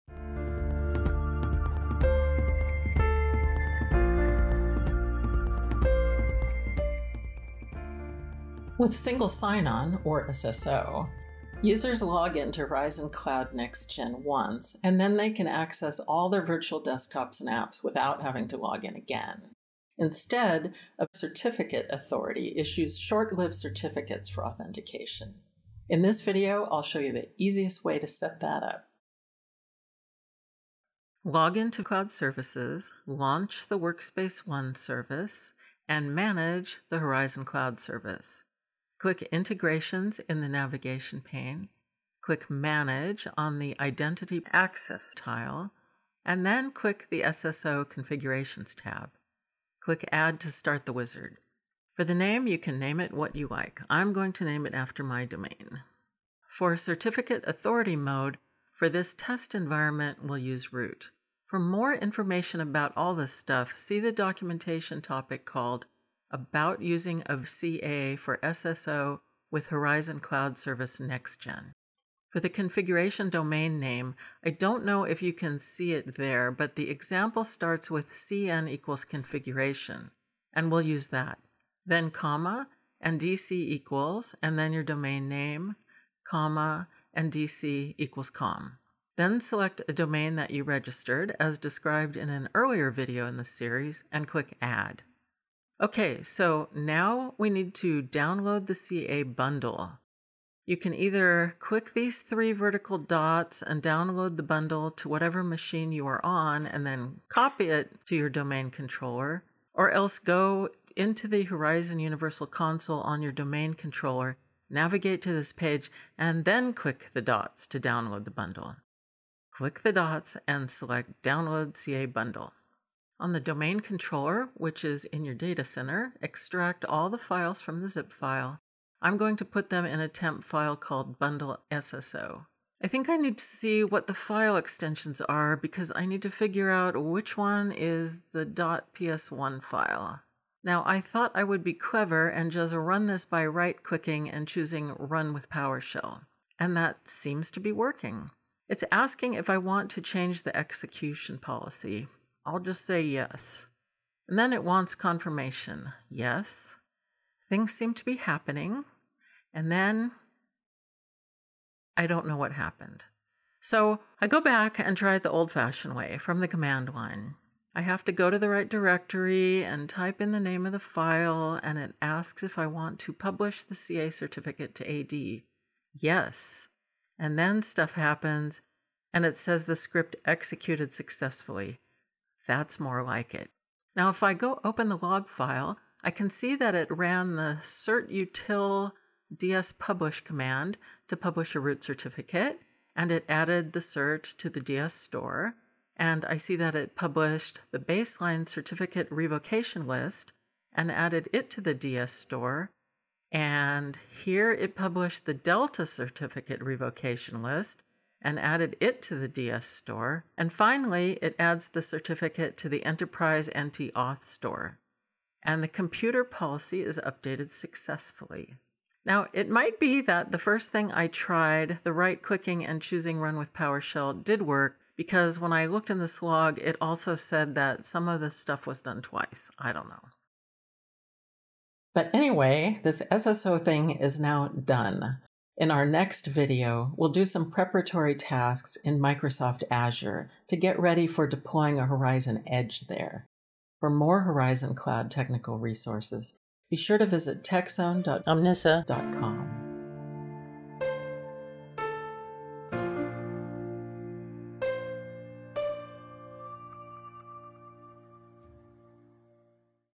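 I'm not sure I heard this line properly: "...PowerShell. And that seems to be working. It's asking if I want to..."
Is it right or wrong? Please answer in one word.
right.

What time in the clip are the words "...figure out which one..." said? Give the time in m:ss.
2:16.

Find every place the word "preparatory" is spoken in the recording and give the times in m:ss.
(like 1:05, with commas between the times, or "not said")
3:57.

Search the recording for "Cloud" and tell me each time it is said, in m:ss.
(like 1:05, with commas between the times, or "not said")
0:13, 0:31, 0:37, 1:10, 4:04.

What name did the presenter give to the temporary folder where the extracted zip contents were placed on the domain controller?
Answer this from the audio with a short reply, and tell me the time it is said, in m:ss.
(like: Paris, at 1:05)
bundle SSO, at 2:11.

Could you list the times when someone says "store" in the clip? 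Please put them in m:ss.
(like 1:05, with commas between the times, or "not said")
3:14, 3:22, 3:29, 3:34.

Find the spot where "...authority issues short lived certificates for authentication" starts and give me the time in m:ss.
0:21.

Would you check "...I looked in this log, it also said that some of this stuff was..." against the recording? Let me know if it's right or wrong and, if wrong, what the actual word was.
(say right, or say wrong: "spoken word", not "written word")
right.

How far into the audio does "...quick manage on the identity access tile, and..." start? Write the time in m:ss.
0:42.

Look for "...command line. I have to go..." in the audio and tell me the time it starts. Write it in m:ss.
2:46.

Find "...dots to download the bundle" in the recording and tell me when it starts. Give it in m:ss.
1:57.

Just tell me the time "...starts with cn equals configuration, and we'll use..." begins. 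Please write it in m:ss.
1:17.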